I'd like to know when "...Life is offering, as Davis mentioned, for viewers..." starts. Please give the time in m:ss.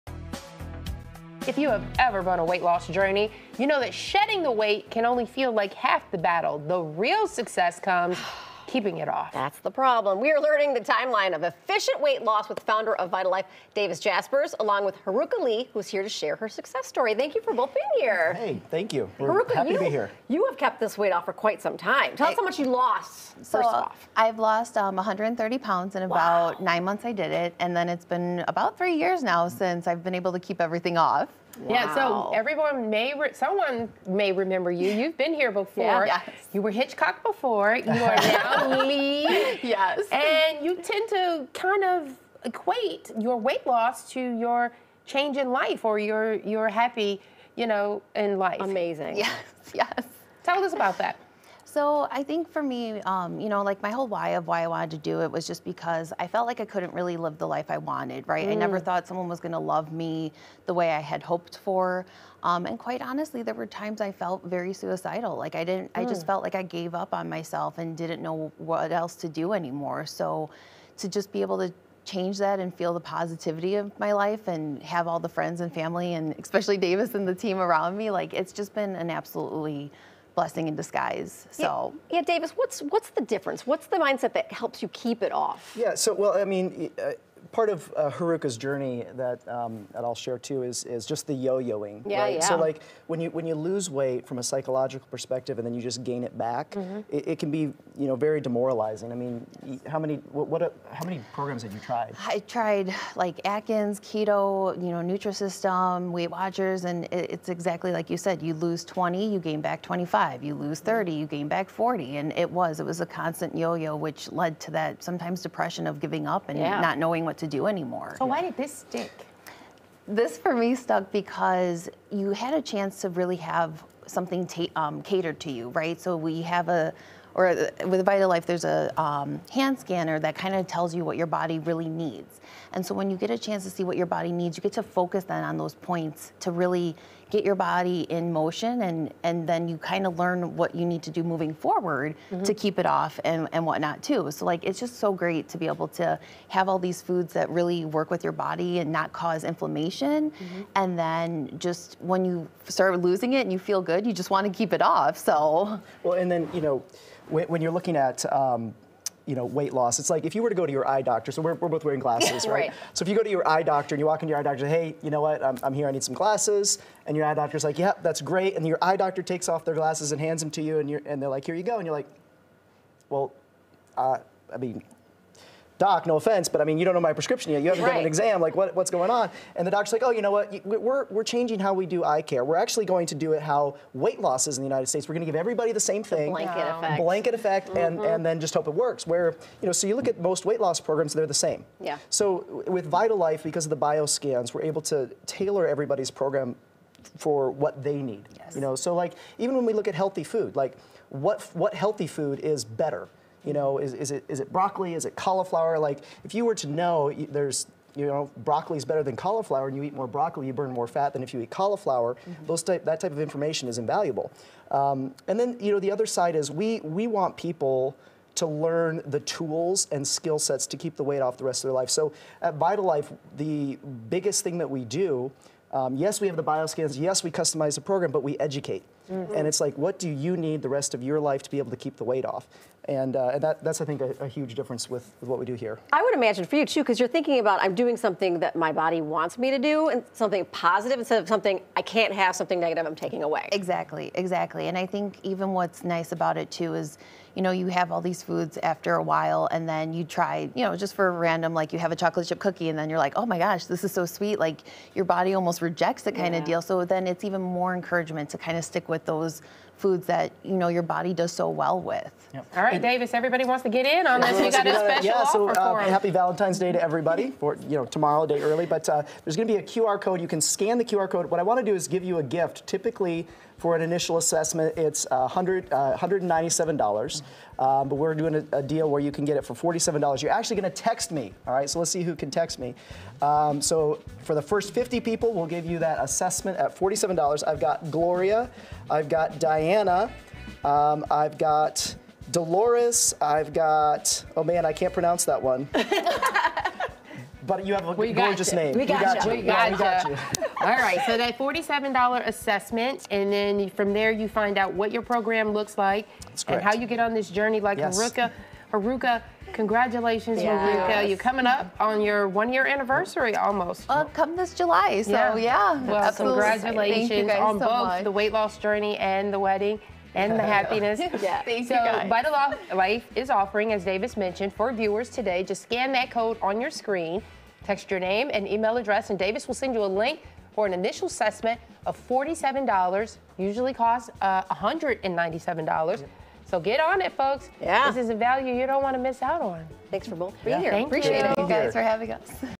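5:22.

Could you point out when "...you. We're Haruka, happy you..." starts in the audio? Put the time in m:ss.
0:18.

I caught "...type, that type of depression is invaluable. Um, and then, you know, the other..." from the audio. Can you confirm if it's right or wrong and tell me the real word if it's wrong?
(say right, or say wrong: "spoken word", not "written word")
wrong: "information", not "depression".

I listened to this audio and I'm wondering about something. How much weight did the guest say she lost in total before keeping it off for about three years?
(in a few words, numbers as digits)
130 pounds.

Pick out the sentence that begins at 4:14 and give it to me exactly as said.
Like your body almost rejects the kind yeah.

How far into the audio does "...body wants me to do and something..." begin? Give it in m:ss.
3:58.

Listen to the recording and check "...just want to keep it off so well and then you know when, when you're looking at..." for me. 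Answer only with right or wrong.
right.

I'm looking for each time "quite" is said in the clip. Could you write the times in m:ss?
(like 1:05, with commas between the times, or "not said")
0:21, 1:02.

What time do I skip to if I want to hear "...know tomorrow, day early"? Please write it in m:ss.
4:27.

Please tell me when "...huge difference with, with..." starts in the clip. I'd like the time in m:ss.
3:54.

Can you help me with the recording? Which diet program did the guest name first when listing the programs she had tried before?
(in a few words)
Atkins.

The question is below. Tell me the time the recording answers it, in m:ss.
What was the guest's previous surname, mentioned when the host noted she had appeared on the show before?
0:36.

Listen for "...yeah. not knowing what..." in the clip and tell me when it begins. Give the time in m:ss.
1:56.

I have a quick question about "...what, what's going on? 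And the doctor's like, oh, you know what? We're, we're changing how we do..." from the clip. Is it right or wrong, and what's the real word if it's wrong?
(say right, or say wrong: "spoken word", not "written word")
right.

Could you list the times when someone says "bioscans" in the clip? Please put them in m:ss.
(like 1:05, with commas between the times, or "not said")
3:13, 3:46.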